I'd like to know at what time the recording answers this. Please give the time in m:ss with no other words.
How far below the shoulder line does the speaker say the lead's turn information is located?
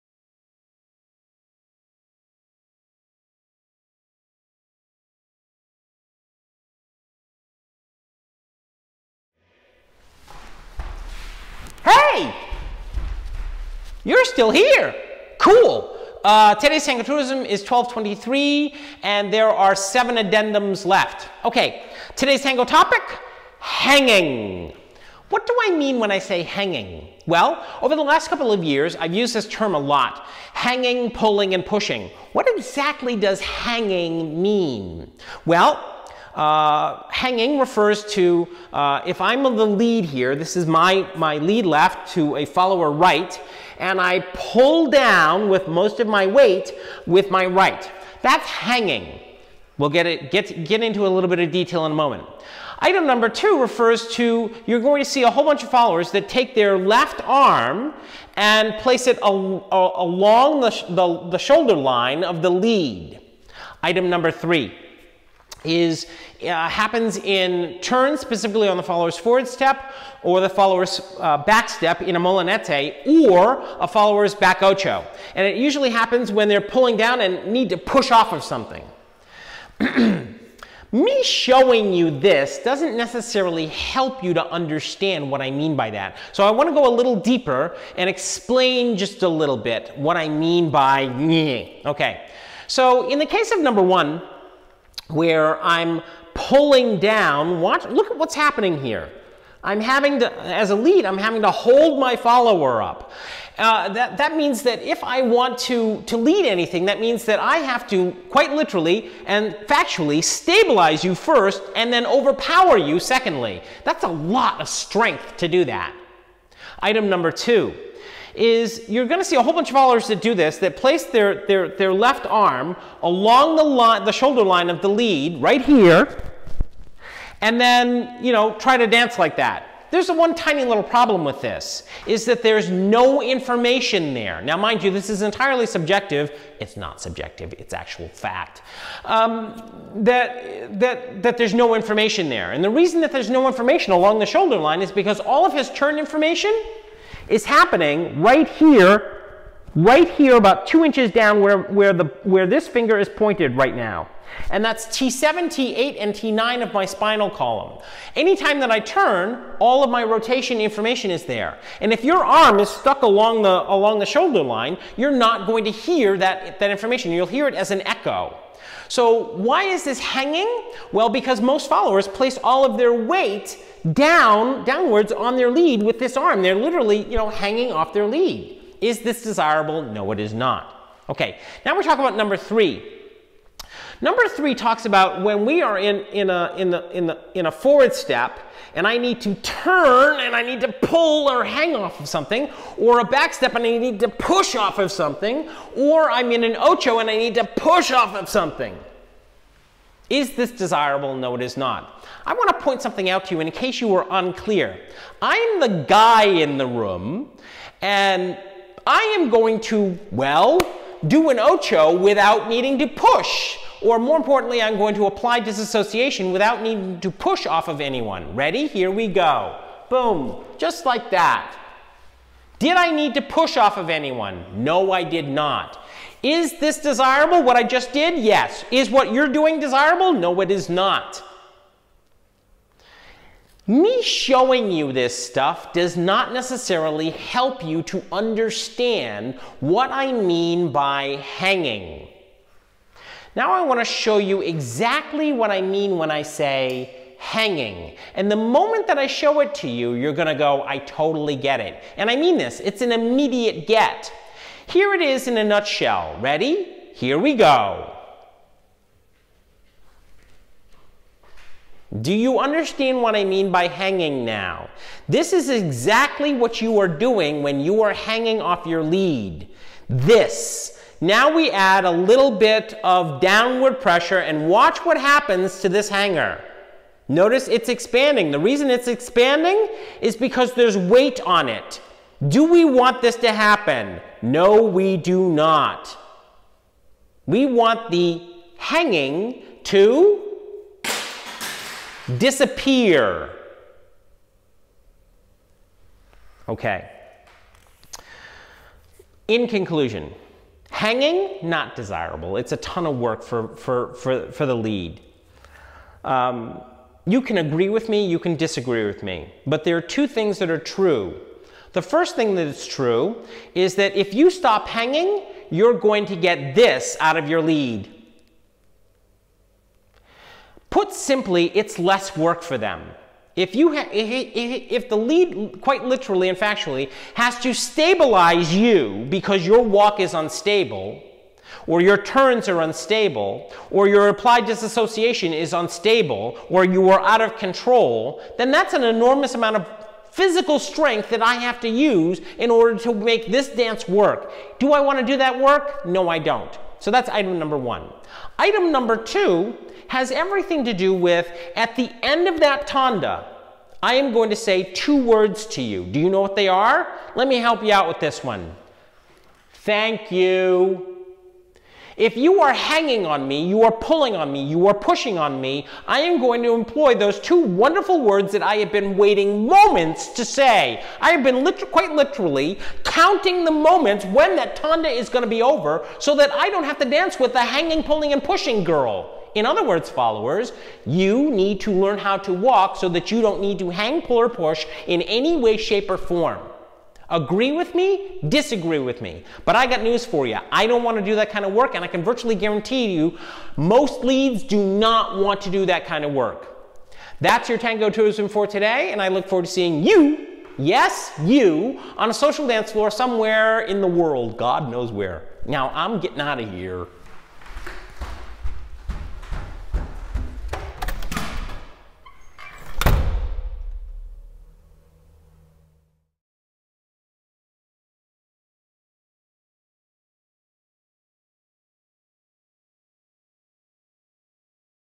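2:30.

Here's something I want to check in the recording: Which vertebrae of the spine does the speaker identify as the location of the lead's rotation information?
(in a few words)
T7, T8, and T9.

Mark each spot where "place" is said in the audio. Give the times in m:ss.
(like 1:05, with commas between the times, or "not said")
0:58, 2:00, 2:52.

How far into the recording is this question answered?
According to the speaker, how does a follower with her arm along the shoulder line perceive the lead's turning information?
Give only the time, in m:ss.
2:47.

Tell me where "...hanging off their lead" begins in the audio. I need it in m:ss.
2:57.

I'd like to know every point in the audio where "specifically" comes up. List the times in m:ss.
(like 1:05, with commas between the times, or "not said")
1:08.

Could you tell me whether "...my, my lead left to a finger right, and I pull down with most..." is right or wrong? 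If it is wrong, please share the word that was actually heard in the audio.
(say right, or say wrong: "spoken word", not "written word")
wrong: "follower", not "finger".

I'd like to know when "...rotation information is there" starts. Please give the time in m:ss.
2:40.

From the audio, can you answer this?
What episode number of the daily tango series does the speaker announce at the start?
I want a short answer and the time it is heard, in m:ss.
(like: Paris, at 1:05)
1223, at 0:17.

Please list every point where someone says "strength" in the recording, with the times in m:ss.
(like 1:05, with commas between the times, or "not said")
1:54, 5:40.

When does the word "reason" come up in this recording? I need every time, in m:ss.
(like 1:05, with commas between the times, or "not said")
2:22, 4:38.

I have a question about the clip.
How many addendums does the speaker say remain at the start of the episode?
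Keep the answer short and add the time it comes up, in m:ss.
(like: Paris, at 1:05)
7, at 0:19.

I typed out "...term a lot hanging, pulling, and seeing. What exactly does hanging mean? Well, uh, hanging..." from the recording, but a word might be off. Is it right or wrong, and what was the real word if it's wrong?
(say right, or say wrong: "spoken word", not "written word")
wrong: "pushing", not "seeing".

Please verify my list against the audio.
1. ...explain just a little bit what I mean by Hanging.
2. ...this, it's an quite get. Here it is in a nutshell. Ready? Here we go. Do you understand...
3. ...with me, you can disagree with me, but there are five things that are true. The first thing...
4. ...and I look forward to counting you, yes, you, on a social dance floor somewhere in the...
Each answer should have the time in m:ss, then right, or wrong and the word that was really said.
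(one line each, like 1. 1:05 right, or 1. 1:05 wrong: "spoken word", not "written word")
1. 1:28 wrong: "Okay", not "Hanging"
2. 4:12 wrong: "immediate", not "quite"
3. 5:07 wrong: "two", not "five"
4. 6:38 wrong: "seeing", not "counting".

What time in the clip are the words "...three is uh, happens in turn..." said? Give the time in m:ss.
1:04.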